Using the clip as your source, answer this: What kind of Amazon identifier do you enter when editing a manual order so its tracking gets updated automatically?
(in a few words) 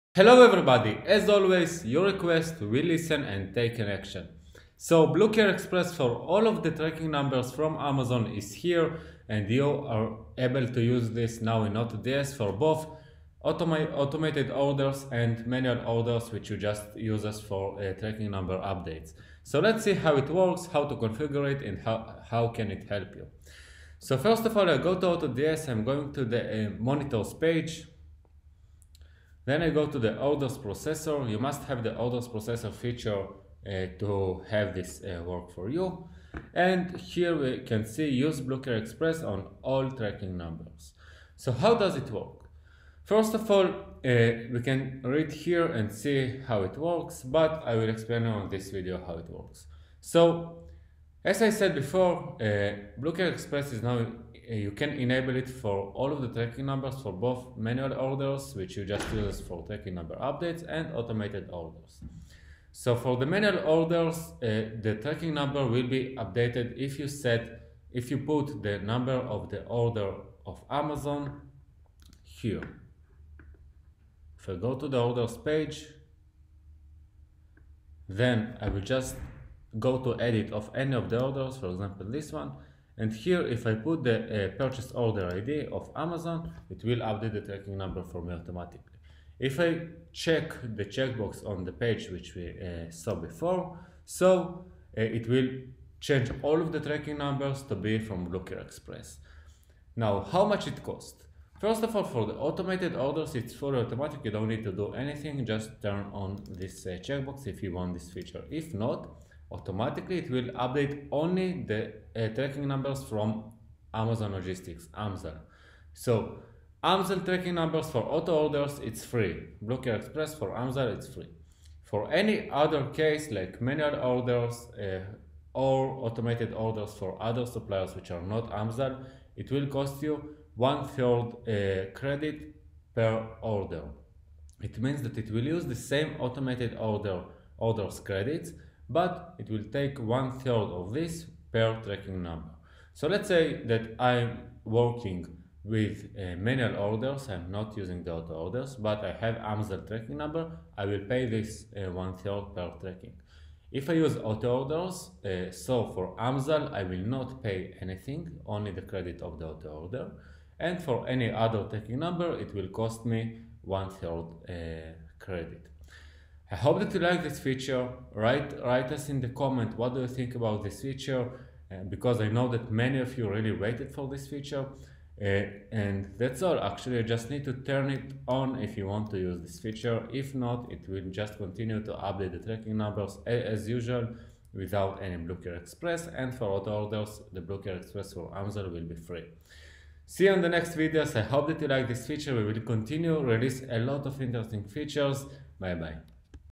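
Purchase order ID.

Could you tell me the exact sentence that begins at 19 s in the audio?
So let's see how it works, how to configure it and how, how can it help you.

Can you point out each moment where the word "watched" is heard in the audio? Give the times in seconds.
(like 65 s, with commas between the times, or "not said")
not said.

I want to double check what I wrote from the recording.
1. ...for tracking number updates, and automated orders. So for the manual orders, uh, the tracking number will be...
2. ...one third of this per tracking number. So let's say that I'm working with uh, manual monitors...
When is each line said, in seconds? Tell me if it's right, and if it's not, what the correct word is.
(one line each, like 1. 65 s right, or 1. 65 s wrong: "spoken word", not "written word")
1. 59 s right
2. 139 s wrong: "orders", not "monitors".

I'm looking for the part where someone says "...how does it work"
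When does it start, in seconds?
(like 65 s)
41 s.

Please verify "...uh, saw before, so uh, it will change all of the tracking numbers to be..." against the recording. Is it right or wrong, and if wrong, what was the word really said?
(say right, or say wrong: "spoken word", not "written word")
right.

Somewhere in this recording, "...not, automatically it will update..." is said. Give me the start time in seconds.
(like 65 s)
108 s.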